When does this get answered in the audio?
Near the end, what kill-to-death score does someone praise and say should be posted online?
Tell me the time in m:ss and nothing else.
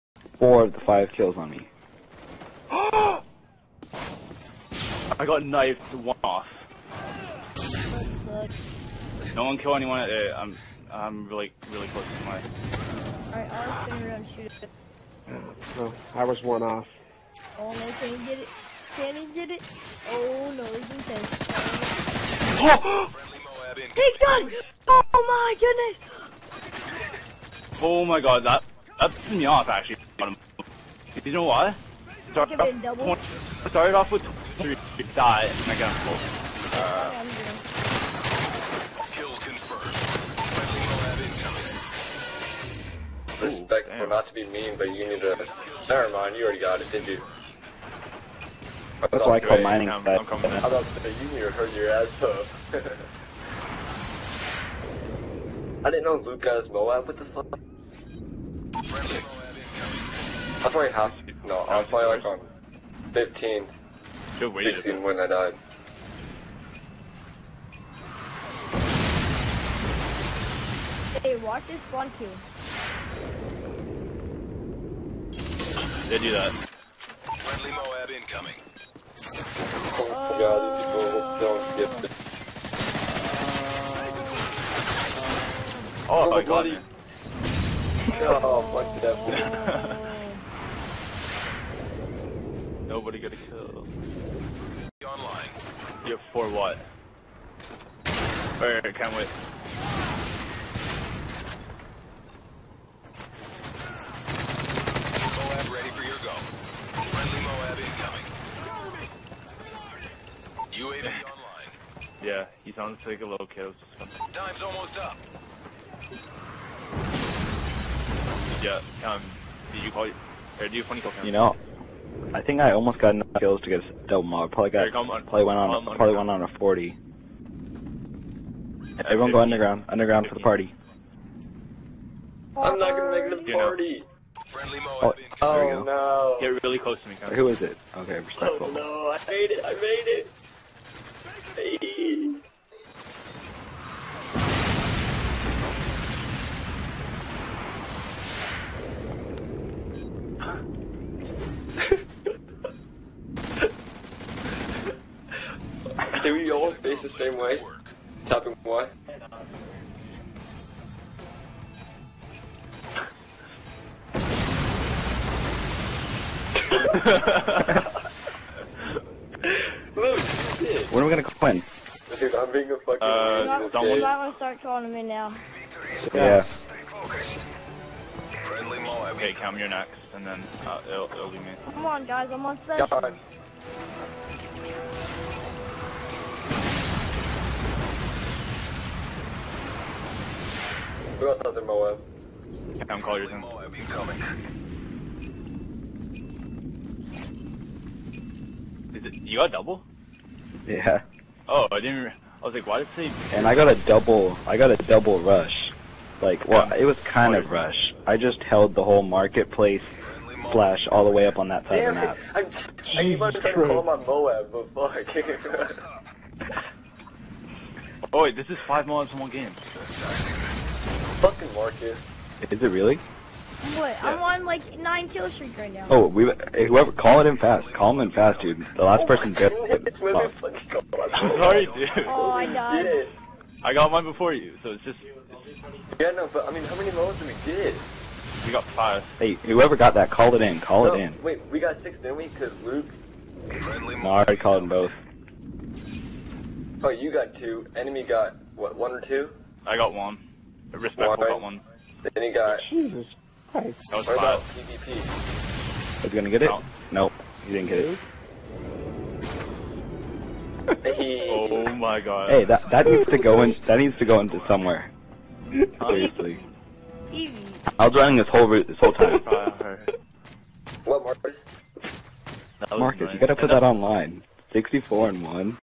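4:34.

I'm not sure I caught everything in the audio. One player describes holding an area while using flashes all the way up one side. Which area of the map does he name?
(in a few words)
Marketplace.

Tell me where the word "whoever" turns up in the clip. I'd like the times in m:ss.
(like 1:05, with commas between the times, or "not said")
3:46, 3:59.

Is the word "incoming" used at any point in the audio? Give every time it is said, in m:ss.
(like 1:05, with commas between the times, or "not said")
1:18, 1:51, 3:13.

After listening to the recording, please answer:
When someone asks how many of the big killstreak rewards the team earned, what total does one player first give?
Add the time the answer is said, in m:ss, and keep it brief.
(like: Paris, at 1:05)
5, at 3:58.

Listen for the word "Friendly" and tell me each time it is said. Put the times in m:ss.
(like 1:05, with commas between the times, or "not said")
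1:16, 1:47, 2:58.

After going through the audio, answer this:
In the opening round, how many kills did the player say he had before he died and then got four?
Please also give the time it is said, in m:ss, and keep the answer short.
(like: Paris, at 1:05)
3, at 0:34.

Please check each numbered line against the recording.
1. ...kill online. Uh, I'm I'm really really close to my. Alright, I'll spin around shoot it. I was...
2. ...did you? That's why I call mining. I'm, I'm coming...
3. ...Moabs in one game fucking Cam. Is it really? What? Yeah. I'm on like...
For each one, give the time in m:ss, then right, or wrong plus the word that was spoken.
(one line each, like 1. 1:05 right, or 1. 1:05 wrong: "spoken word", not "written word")
1. 0:09 wrong: "anyone", not "online"
2. 0:46 right
3. 3:38 wrong: "Marcus", not "Cam".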